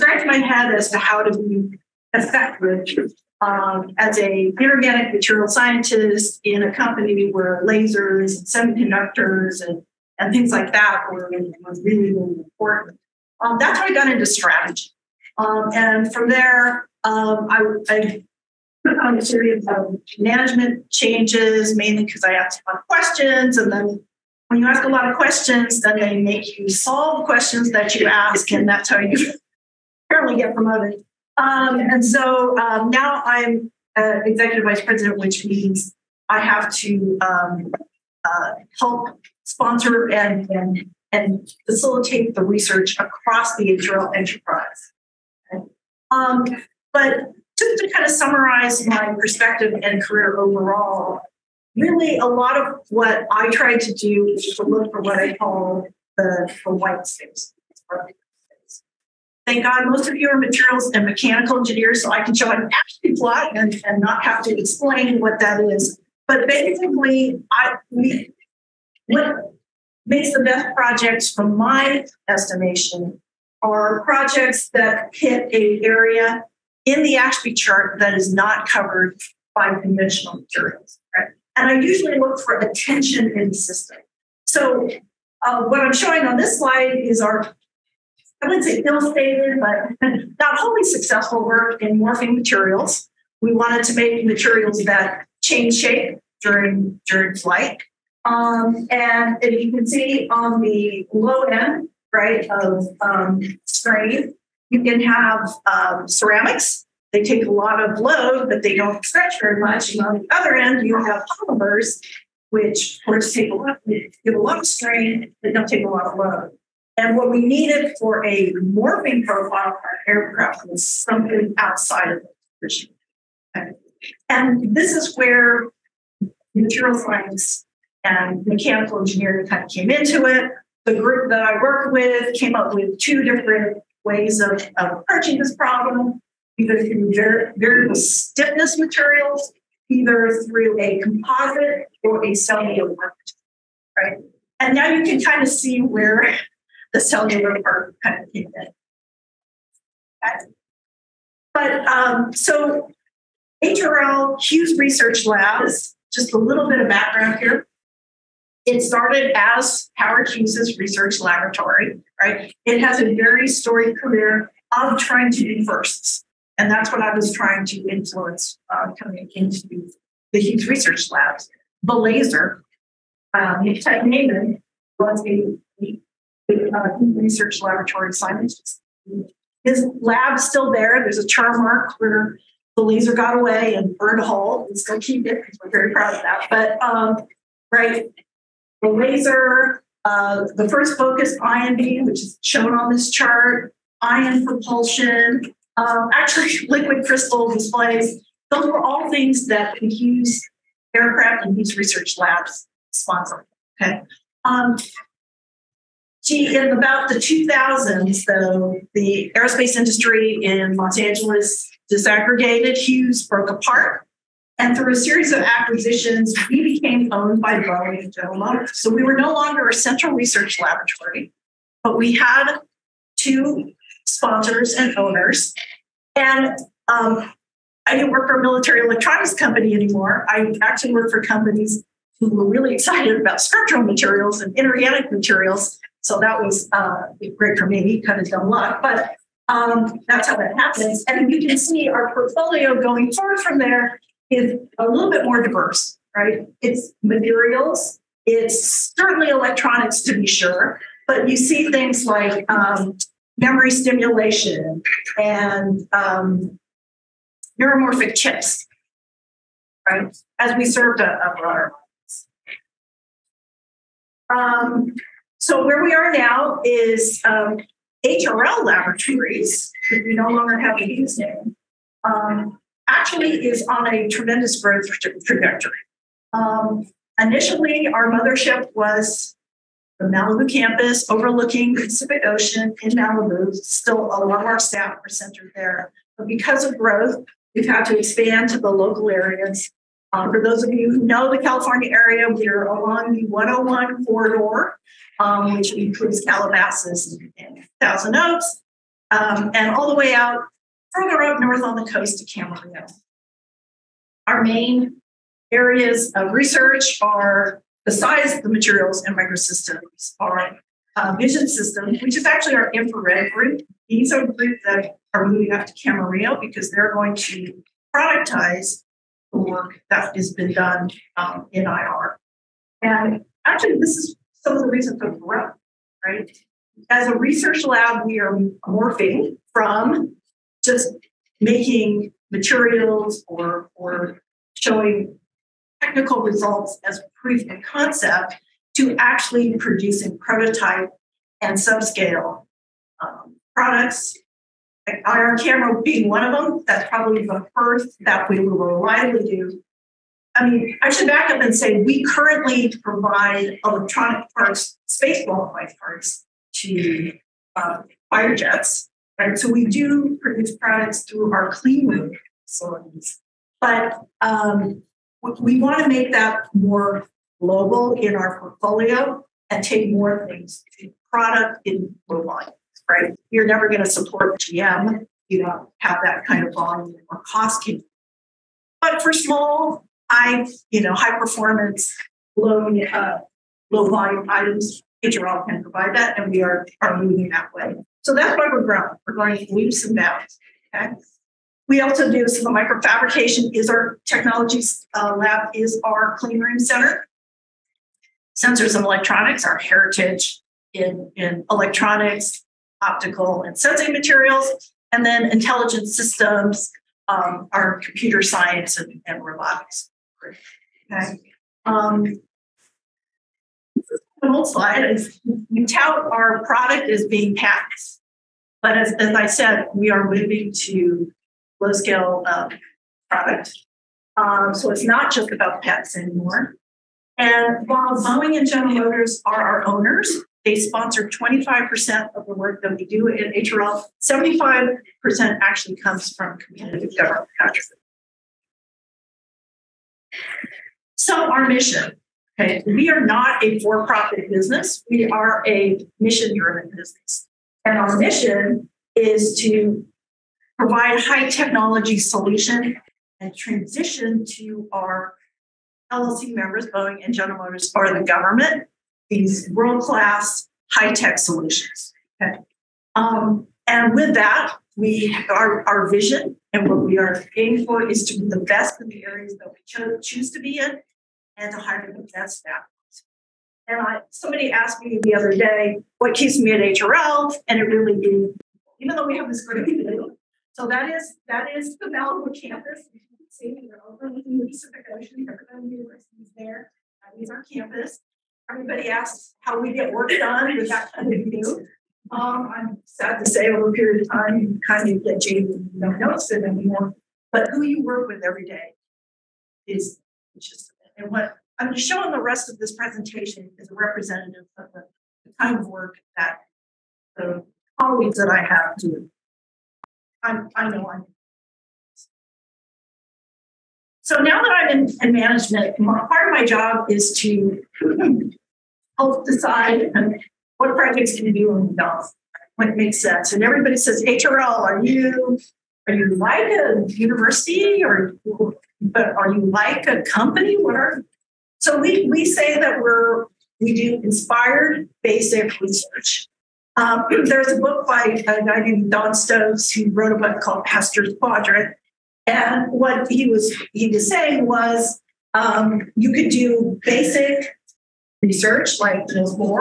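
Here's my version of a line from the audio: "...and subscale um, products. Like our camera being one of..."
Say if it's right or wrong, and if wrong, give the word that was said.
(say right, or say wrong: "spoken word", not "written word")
right.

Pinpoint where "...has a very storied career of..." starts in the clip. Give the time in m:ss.
2:42.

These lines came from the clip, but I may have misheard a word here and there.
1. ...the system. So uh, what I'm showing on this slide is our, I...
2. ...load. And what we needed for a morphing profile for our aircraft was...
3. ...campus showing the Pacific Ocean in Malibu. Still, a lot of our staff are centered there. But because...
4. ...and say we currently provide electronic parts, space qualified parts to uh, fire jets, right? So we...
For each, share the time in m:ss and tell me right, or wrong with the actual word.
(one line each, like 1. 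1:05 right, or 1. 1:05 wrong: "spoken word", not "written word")
1. 1:23 right
2. 1:56 right
3. 4:40 wrong: "overlooking", not "showing"
4. 5:51 right.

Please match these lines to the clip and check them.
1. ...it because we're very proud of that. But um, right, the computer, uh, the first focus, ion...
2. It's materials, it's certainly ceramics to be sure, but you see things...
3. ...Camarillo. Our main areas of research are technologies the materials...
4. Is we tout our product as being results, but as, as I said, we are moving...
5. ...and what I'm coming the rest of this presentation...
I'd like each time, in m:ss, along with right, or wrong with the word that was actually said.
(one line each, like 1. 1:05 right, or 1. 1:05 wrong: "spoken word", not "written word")
1. 3:05 wrong: "laser", not "computer"
2. 4:06 wrong: "electronics", not "ceramics"
3. 5:02 wrong: "besides", not "technologies"
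4. 6:54 wrong: "patents", not "results"
5. 8:20 wrong: "showing", not "coming".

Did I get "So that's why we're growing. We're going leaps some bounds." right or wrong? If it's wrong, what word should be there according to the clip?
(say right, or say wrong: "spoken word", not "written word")
right.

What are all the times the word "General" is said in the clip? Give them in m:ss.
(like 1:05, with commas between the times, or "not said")
3:38, 7:08, 7:37.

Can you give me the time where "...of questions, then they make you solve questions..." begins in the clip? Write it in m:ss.
0:25.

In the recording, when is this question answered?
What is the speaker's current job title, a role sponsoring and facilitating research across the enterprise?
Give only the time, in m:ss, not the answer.
0:34.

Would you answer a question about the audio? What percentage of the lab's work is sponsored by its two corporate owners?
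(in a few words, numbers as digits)
25%.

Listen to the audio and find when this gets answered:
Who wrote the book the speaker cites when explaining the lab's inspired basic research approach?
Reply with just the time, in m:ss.
8:58.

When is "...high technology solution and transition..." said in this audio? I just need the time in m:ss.
7:30.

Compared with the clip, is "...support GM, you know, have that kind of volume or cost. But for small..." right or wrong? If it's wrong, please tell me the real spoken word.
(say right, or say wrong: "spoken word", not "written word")
right.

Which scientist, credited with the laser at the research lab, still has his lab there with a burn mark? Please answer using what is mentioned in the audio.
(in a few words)
Ted Maiman.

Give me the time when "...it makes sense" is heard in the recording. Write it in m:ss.
8:42.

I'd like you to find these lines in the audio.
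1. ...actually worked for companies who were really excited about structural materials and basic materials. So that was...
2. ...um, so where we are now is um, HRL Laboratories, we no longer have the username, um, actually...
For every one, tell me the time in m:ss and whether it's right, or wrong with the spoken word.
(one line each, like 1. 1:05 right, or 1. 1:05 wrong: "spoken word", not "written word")
1. 3:50 wrong: "inorganic", not "basic"
2. 4:24 right.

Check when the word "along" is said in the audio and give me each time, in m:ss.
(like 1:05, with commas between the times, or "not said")
4:52.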